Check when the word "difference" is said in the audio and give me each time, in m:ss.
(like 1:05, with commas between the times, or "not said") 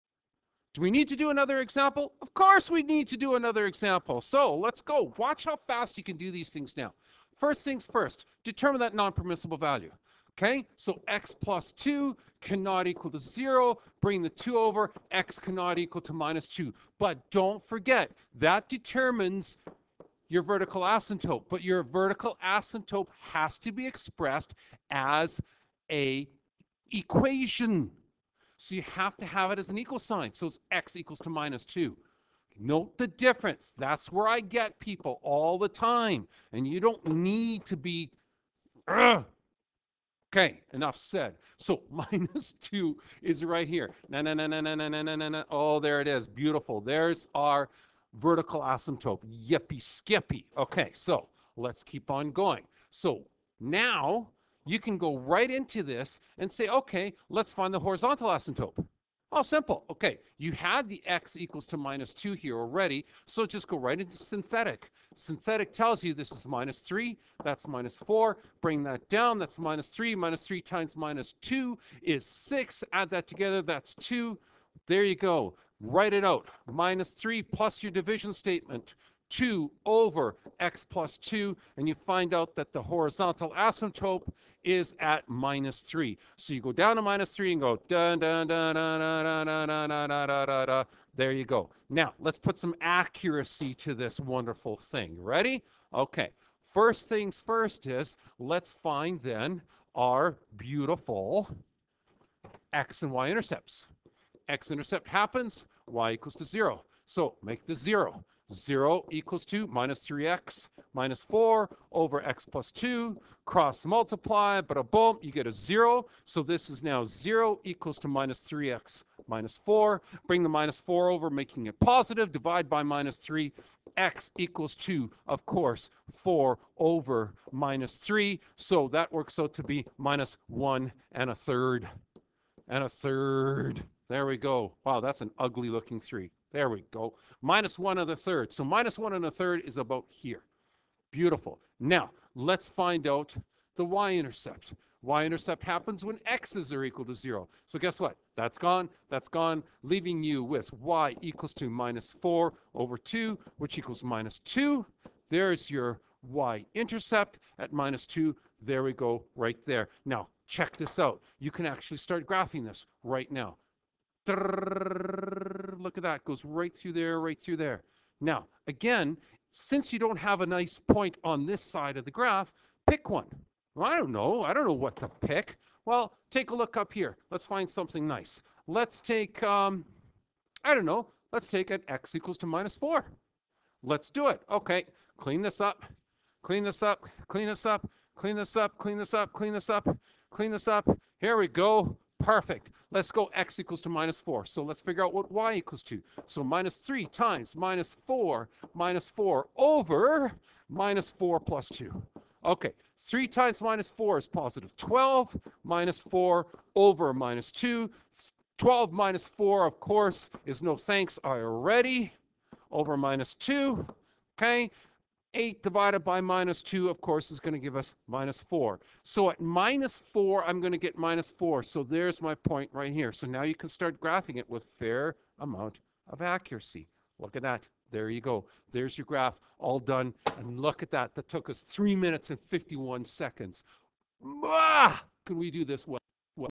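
0:33.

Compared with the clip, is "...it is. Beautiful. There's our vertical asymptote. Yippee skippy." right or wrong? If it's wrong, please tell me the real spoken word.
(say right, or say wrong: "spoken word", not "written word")
right.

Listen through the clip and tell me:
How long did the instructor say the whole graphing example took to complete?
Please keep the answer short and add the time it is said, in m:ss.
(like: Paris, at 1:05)
3 minutes 51 seconds, at 3:51.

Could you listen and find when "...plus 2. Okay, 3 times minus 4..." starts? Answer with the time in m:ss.
3:21.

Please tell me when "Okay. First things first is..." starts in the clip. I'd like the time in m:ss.
1:35.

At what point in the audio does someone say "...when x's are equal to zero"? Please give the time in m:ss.
2:26.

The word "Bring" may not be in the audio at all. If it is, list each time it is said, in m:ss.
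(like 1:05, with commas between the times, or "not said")
0:13, 1:08, 2:00.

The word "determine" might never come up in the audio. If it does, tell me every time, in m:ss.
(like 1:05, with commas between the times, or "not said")
0:08, 0:18.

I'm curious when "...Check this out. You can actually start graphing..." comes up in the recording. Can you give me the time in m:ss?
2:40.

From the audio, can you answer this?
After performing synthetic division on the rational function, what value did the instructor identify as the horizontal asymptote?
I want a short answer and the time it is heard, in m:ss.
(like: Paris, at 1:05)
-3, at 1:22.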